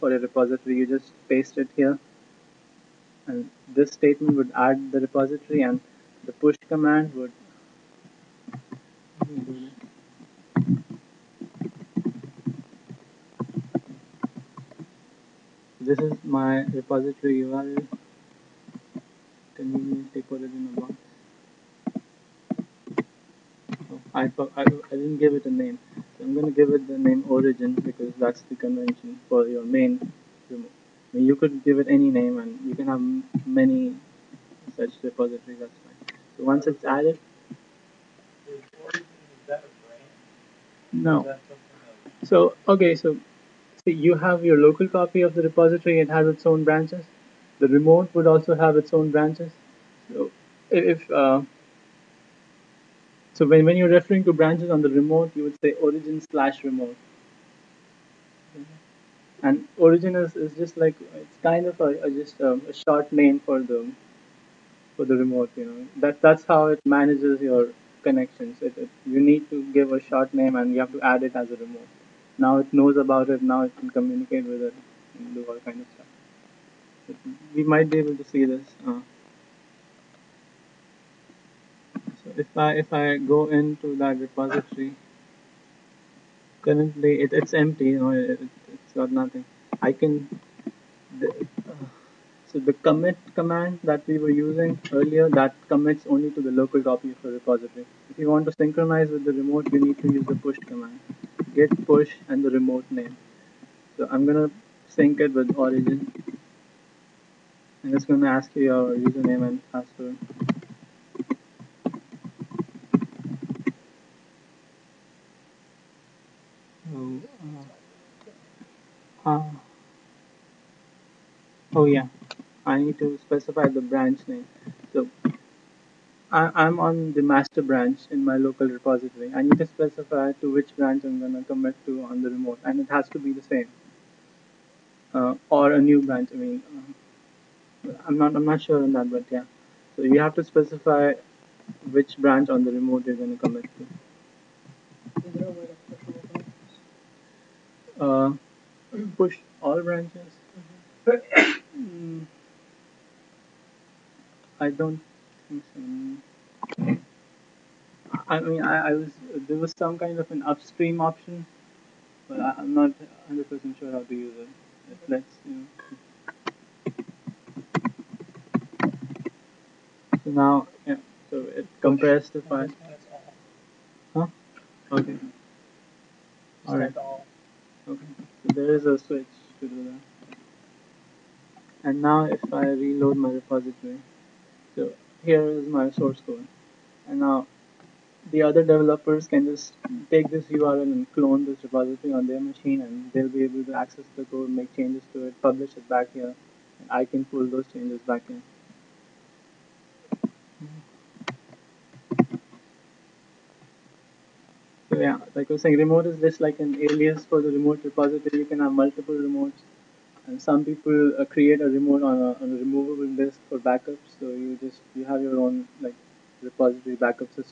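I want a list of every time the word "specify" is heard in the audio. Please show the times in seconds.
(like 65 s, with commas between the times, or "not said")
123 s, 129 s, 140 s.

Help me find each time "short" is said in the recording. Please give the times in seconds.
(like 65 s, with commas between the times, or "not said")
62 s, 69 s.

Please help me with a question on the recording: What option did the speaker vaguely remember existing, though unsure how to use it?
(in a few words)
upstream option.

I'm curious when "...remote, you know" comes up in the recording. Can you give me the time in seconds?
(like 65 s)
65 s.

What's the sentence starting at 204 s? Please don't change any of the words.
So yeah, like I was saying, remote is just like an alias for the remote repository.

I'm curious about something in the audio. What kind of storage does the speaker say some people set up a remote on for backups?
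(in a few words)
a removable disk.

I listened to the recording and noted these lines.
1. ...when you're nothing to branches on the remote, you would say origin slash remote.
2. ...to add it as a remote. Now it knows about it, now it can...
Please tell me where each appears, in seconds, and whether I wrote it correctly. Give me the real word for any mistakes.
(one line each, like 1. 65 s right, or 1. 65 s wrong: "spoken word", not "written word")
1. 53 s wrong: "referring", not "nothing"
2. 70 s right.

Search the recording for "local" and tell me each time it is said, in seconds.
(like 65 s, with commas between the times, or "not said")
44 s, 96 s, 128 s.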